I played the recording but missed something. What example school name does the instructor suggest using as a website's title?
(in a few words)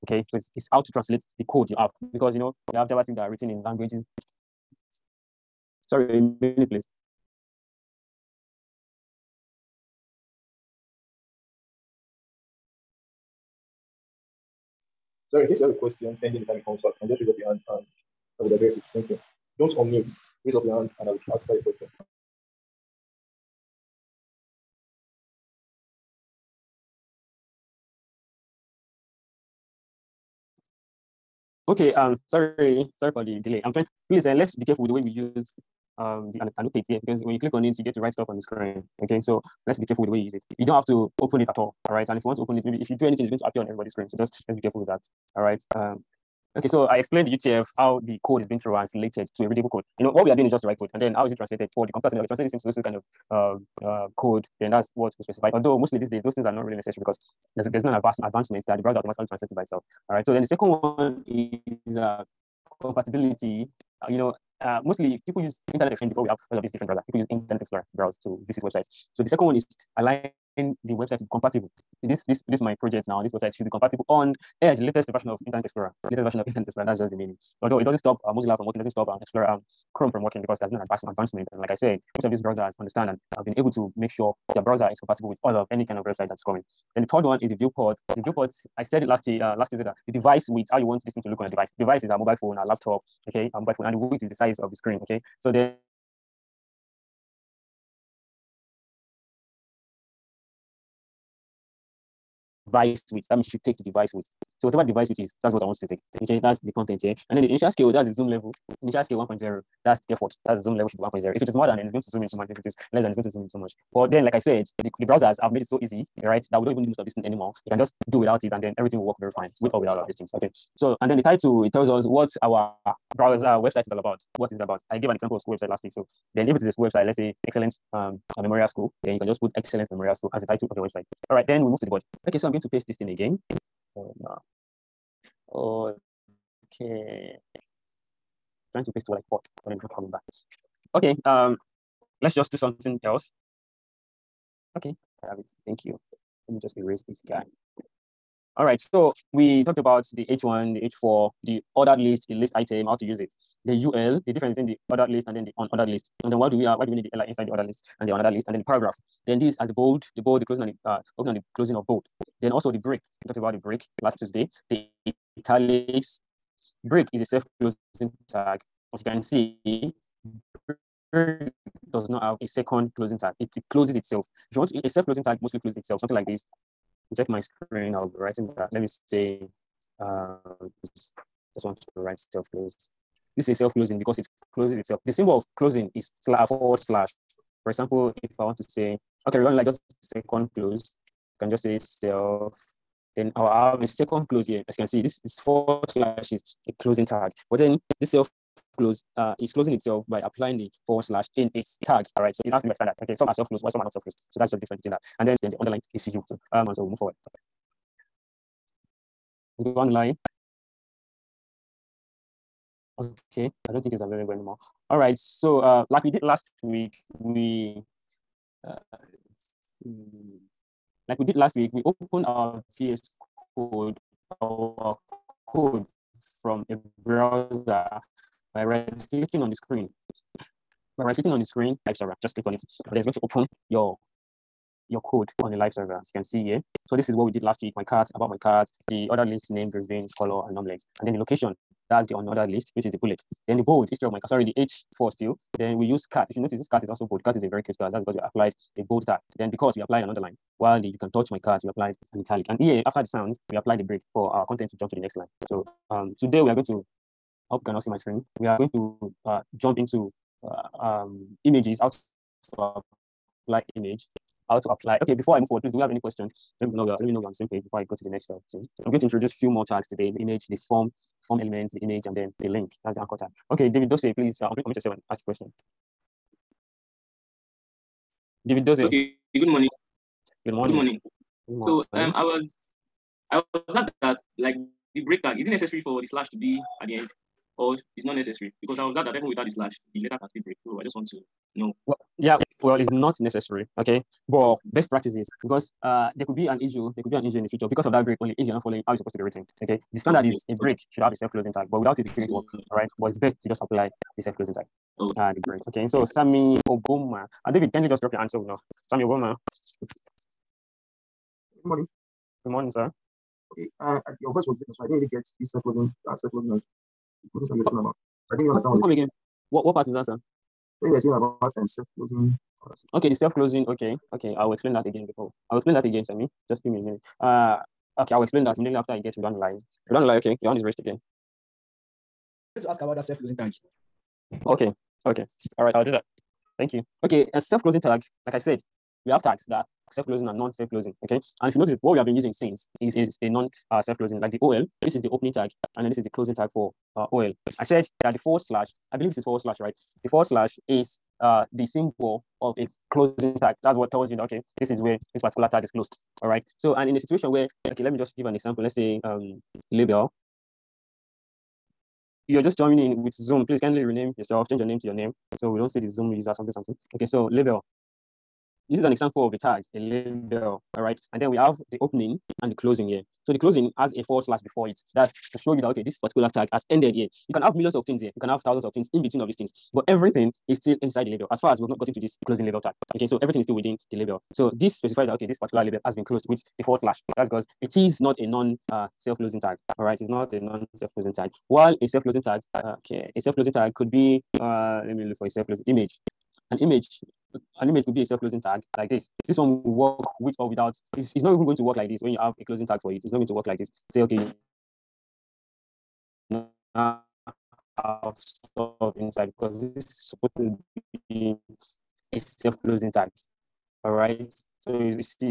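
Excellent Memorial School.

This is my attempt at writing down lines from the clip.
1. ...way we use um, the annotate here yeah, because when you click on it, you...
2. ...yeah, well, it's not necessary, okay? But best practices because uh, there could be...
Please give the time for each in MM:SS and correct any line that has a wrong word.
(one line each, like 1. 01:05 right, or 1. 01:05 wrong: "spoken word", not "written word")
1. 00:34 right
2. 04:52 right.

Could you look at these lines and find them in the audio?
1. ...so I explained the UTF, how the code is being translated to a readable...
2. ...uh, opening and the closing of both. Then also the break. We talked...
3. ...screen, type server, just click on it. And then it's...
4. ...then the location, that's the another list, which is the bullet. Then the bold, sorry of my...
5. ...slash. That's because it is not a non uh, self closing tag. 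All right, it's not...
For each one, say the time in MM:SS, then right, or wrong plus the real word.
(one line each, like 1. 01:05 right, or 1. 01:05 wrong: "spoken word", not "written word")
1. 00:46 right
2. 02:40 right
3. 03:51 right
4. 04:01 wrong: "history", not "sorry"
5. 06:26 right.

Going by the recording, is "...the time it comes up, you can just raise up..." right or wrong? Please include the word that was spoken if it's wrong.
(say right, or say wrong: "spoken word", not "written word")
right.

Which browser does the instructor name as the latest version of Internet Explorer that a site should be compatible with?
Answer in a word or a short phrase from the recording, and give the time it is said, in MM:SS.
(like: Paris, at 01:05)
Edge, at 01:14.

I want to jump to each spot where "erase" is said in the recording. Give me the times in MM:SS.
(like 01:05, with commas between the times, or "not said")
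02:26.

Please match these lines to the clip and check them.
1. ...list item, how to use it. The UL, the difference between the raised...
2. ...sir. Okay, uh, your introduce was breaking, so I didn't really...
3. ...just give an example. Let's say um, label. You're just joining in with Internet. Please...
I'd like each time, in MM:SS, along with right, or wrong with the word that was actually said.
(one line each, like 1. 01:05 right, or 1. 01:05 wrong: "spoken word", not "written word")
1. 02:32 wrong: "ordered", not "raised"
2. 05:12 wrong: "voice", not "introduce"
3. 05:57 wrong: "Zoom", not "Internet".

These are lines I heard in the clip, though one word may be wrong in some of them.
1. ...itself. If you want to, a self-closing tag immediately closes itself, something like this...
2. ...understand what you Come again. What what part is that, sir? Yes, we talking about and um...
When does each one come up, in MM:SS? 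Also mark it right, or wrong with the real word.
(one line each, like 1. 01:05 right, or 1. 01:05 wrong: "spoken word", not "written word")
1. 02:53 wrong: "mostly", not "immediately"
2. 05:18 right.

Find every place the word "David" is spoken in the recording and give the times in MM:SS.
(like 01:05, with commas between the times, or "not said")
04:33, 04:38, 05:07.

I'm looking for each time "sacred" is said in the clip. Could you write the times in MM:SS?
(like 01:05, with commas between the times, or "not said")
not said.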